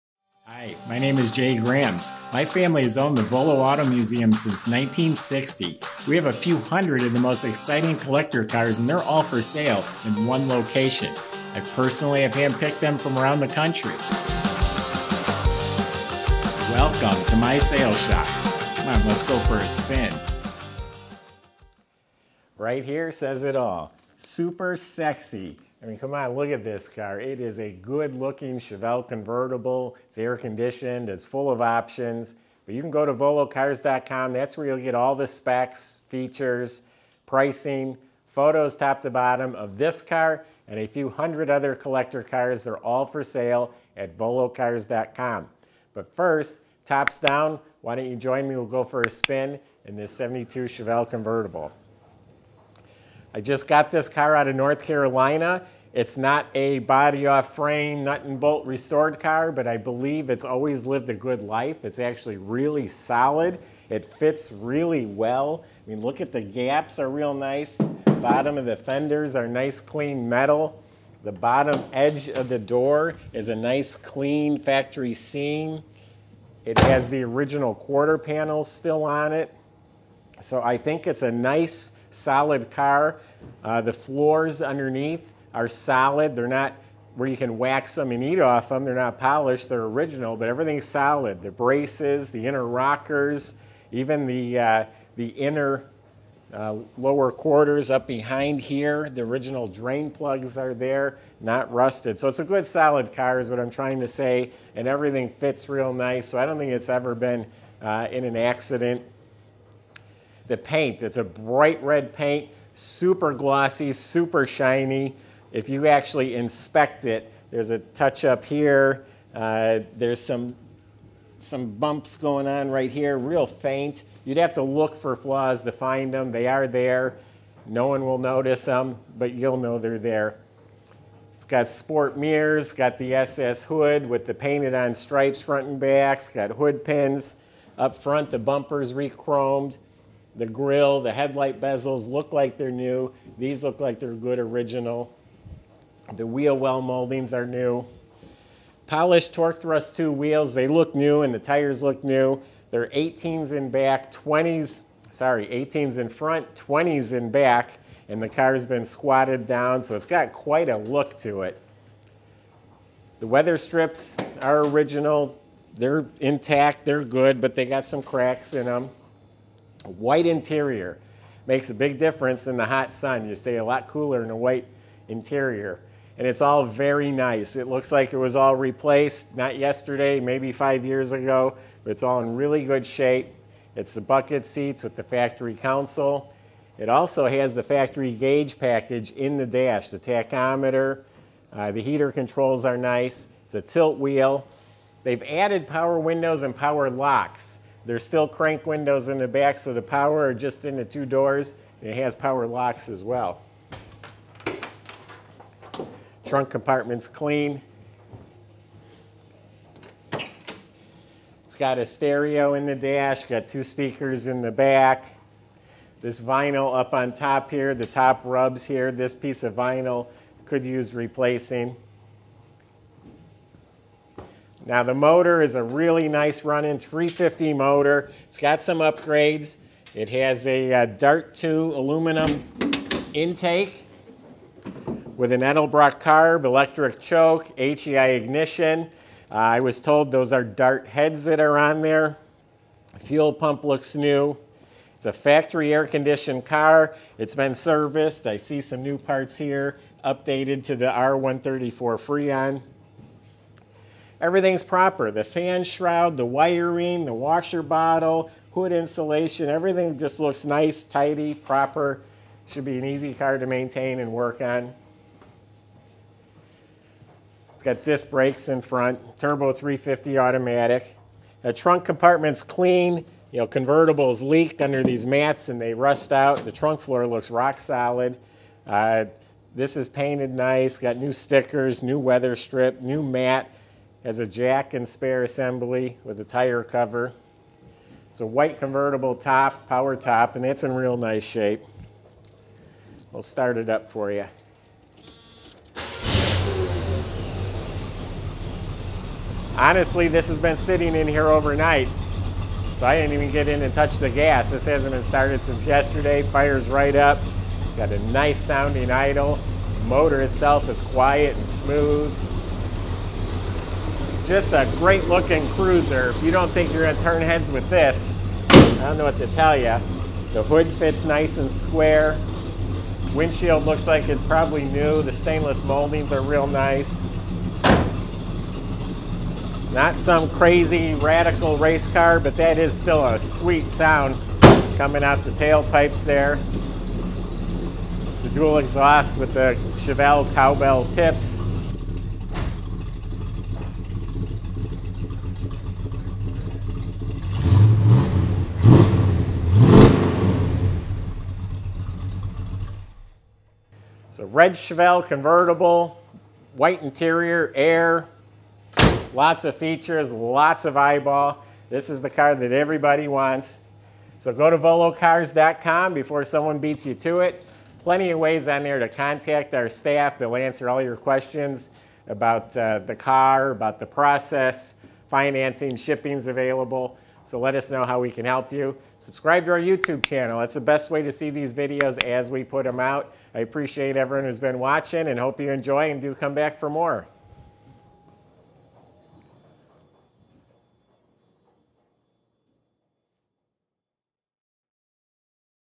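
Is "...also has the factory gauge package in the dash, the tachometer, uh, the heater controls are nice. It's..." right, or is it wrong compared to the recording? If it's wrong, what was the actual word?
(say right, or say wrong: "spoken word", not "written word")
right.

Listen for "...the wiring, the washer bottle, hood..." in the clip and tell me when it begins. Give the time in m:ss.
4:16.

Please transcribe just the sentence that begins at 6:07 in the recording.
Plenty of ways on there to contact our staff.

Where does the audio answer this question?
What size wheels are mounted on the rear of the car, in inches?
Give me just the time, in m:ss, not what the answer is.
2:36.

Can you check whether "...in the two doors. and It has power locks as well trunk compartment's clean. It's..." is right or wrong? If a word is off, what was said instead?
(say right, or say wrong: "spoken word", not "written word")
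right.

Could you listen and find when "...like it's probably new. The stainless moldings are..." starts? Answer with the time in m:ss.
5:23.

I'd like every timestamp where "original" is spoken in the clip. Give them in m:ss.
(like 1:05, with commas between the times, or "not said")
1:17, 1:29, 1:39, 2:24, 2:44.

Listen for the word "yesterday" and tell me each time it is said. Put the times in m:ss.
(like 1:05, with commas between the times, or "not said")
2:59, 5:05.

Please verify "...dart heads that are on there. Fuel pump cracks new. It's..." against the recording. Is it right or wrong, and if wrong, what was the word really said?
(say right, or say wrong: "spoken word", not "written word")
wrong: "looks", not "cracks".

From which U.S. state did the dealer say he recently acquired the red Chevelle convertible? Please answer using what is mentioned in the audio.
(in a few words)
North Carolina.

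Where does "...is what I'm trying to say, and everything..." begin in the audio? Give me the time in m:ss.
1:43.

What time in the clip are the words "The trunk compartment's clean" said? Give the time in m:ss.
4:31.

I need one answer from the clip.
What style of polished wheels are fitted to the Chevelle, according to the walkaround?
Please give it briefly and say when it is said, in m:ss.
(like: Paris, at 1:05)
Torque Thrust 2, at 2:29.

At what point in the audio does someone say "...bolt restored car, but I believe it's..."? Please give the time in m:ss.
0:58.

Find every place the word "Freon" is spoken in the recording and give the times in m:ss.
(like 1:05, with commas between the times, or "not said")
4:12.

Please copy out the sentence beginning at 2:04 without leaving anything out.
You'd have to look for flaws to find them.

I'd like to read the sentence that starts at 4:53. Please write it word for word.
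We'll start it up for you.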